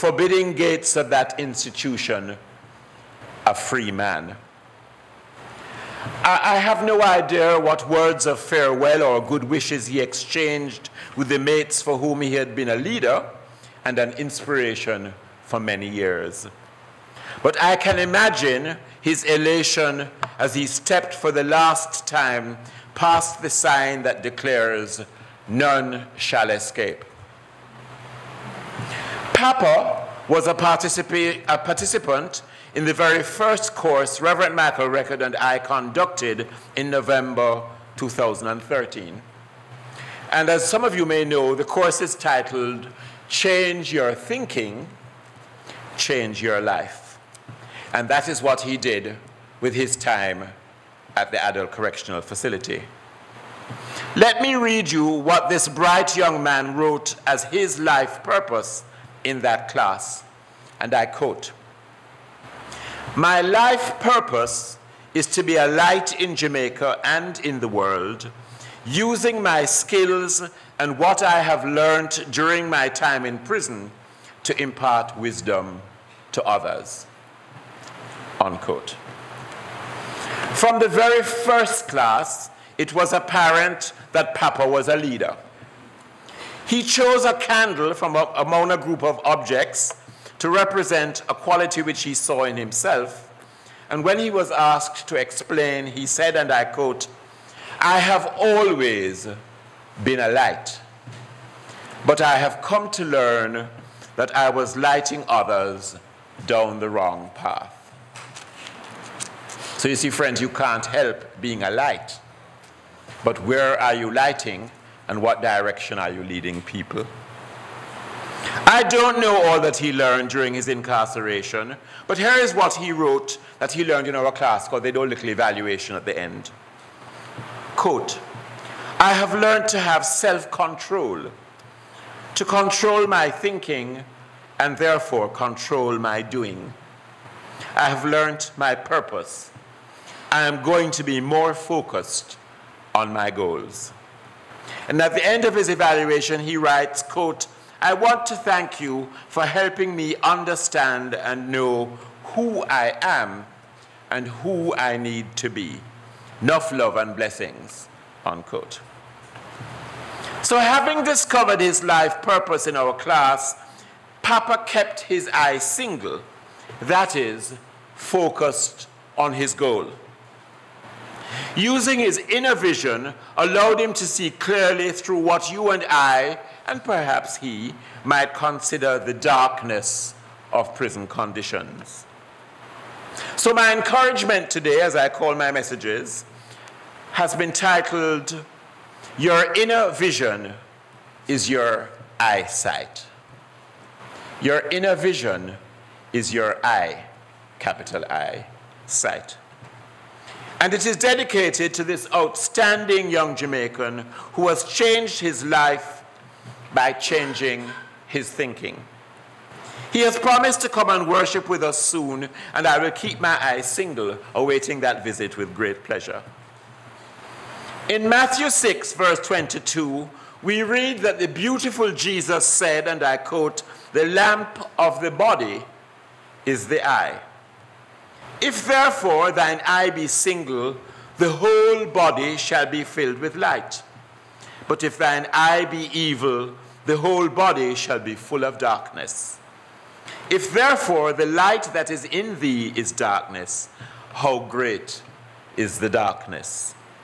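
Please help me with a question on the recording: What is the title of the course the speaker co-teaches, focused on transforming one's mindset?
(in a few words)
Change Your Thinking, Change Your Life.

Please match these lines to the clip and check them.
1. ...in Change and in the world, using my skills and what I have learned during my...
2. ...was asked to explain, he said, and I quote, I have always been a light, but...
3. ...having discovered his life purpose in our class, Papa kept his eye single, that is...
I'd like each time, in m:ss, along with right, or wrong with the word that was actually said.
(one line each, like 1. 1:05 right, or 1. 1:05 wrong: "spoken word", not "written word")
1. 1:06 wrong: "Jamaica", not "Change"
2. 1:34 right
3. 2:40 right.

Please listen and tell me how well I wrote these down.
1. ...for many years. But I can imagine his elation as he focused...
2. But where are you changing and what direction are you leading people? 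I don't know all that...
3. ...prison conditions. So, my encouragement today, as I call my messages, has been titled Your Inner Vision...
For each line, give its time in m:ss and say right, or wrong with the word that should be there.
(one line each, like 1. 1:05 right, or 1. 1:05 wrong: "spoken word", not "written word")
1. 0:15 wrong: "stepped", not "focused"
2. 1:53 wrong: "lighting", not "changing"
3. 3:00 right.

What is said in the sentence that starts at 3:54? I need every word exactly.
But if thine eye be evil, the whole body shall be full of darkness.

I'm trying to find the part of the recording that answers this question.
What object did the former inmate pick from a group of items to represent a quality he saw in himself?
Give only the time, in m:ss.
1:27.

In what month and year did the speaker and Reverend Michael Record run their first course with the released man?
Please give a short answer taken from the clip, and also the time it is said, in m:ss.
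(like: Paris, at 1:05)
November 2013, at 0:36.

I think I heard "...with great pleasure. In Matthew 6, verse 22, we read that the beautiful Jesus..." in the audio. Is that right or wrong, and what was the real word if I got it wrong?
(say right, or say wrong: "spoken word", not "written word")
right.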